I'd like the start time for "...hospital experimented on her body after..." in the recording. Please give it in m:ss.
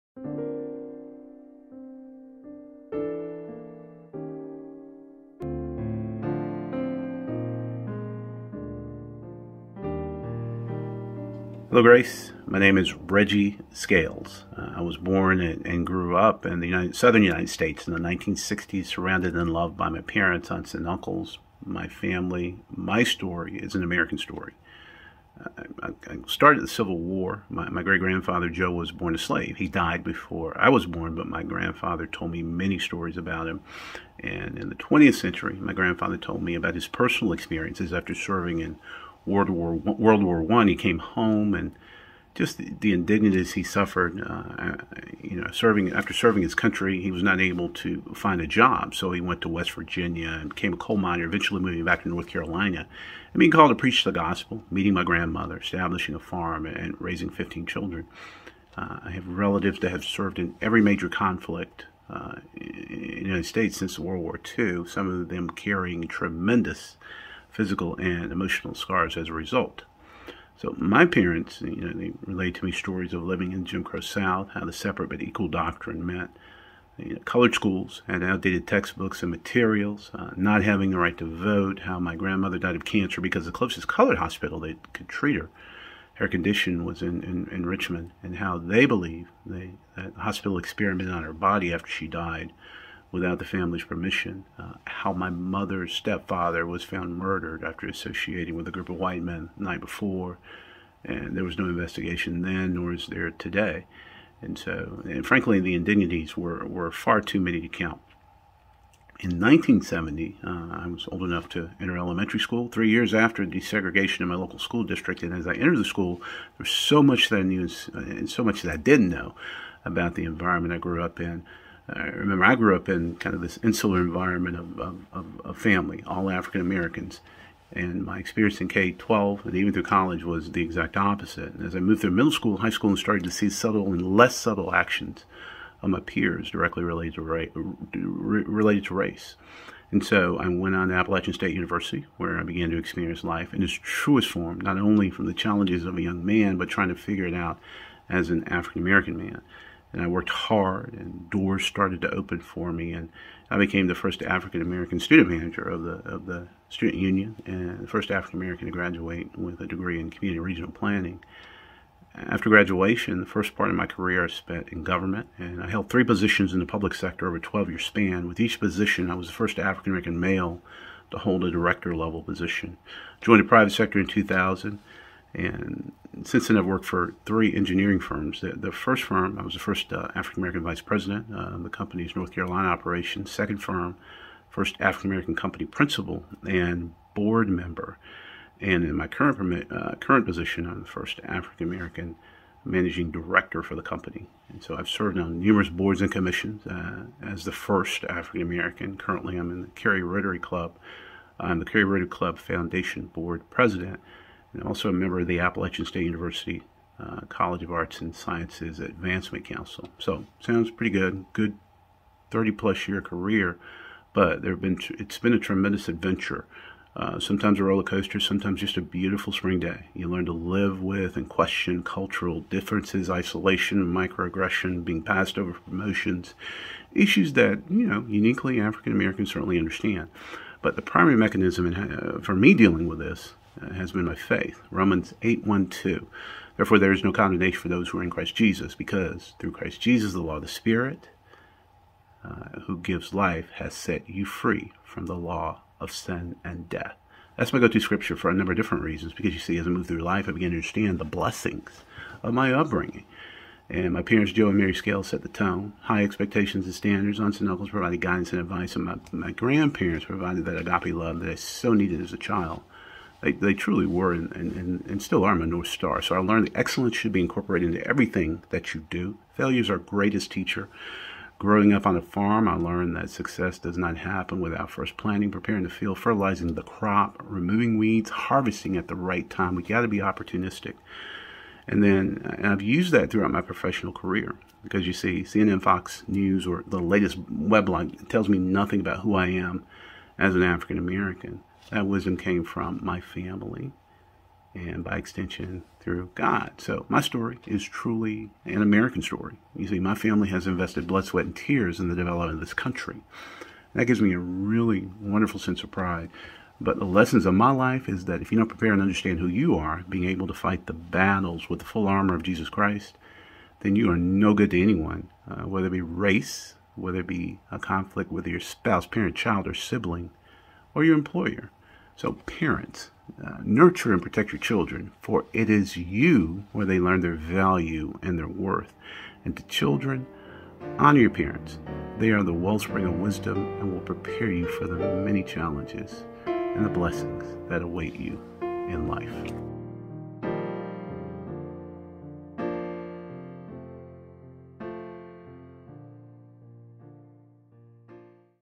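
1:30.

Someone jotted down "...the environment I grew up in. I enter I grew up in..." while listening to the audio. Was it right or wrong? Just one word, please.
wrong.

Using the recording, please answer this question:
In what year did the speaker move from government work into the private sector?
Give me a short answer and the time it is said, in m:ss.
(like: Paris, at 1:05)
2000, at 2:54.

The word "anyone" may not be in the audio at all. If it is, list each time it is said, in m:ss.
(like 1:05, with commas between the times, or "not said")
5:14.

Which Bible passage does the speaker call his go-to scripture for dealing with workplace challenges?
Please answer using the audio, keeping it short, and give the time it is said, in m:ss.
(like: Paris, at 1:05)
Romans 8:1-2, at 3:54.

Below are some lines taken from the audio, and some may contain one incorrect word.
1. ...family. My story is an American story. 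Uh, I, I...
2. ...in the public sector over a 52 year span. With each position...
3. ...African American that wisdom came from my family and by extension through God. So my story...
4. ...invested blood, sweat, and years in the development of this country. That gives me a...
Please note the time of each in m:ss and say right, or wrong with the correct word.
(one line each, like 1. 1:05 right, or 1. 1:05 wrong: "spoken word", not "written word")
1. 0:21 right
2. 2:46 wrong: "12", not "52"
3. 4:50 right
4. 5:00 wrong: "tears", not "years".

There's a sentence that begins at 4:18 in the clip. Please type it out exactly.
And my, my grandparents provided that agape love that I so needed as a child.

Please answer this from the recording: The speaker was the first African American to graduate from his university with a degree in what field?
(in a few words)
Community regional planning.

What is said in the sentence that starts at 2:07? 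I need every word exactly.
And my experience in K 12 and even through college was the exact opposite.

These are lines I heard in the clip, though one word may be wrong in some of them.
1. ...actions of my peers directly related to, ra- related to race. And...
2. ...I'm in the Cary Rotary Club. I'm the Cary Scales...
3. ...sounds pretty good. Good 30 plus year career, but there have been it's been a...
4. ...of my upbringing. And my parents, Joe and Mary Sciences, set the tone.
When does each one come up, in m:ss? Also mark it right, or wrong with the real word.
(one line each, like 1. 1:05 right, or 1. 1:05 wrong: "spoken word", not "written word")
1. 2:14 right
2. 3:19 wrong: "Rotary", not "Scales"
3. 3:30 right
4. 4:12 wrong: "Scales", not "Sciences".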